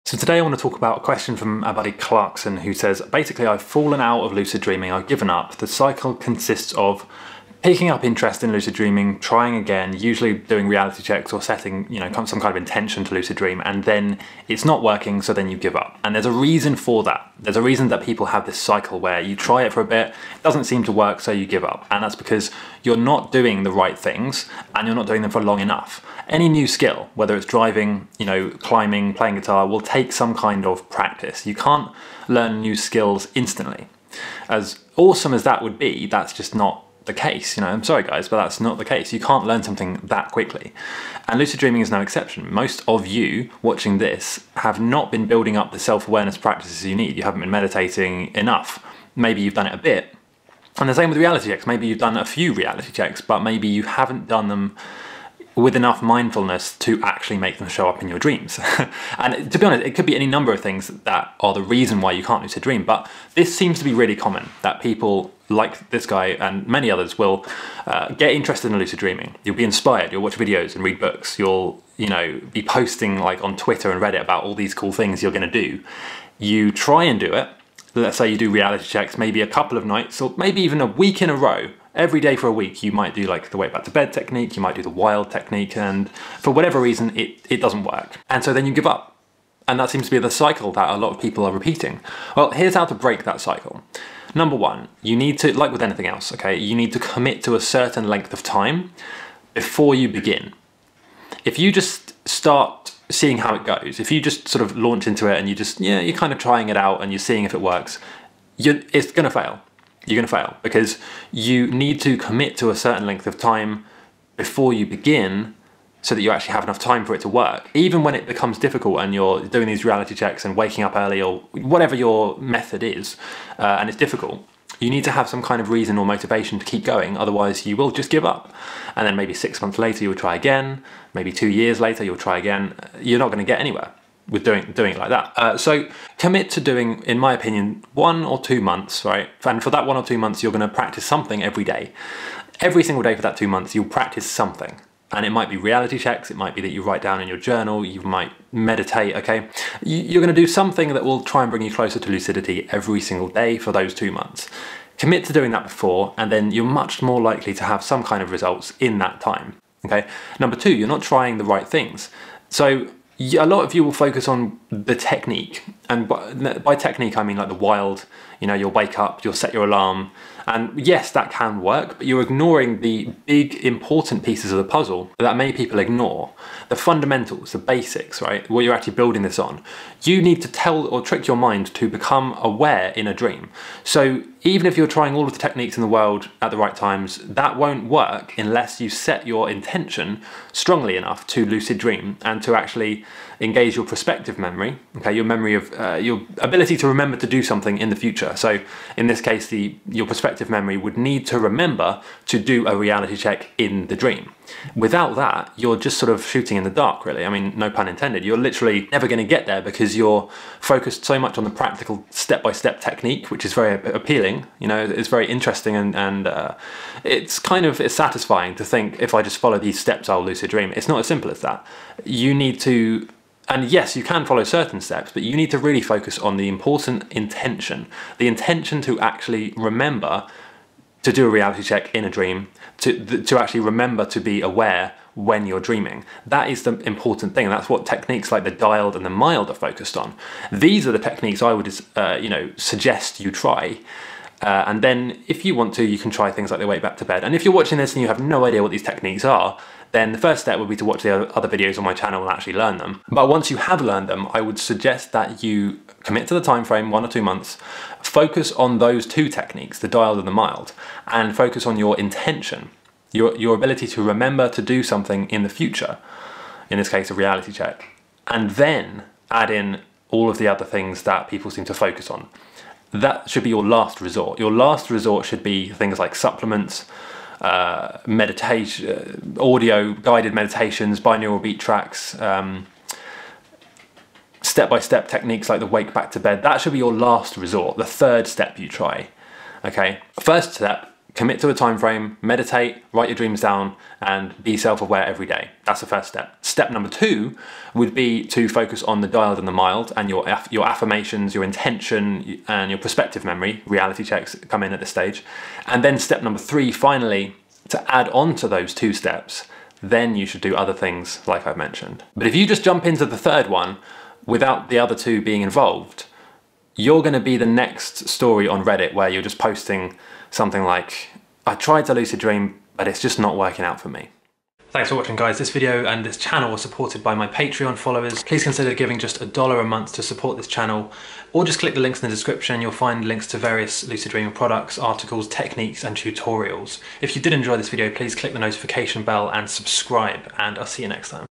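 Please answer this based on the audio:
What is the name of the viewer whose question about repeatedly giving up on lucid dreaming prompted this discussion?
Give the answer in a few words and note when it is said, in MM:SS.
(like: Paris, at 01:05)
Clarkson, at 00:01.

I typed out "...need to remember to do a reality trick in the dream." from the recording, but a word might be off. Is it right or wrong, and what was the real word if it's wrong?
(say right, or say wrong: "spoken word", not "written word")
wrong: "check", not "trick".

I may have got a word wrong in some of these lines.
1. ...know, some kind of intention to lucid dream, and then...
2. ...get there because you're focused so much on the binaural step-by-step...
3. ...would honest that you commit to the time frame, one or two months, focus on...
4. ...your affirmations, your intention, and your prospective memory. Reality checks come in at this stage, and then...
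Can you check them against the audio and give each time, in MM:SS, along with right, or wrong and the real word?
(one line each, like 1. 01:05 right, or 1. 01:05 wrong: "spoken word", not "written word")
1. 00:11 right
2. 03:29 wrong: "practical", not "binaural"
3. 04:14 wrong: "suggest", not "honest"
4. 05:00 right.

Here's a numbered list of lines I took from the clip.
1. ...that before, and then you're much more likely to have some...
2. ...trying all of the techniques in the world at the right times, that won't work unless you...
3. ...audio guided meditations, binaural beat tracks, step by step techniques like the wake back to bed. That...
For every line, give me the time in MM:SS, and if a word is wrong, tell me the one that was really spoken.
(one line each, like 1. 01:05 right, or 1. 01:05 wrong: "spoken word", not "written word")
1. 02:35 right
2. 03:04 right
3. 04:39 right.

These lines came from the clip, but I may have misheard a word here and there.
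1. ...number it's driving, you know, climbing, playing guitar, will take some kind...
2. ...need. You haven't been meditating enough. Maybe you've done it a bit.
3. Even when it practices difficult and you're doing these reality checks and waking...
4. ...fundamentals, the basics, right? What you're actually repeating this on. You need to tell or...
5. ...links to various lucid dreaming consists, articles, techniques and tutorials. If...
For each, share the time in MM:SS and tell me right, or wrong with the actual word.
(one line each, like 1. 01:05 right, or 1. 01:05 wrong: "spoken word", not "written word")
1. 00:27 wrong: "whether", not "number"
2. 00:46 right
3. 01:57 wrong: "becomes", not "practices"
4. 02:56 wrong: "building", not "repeating"
5. 05:33 wrong: "products", not "consists".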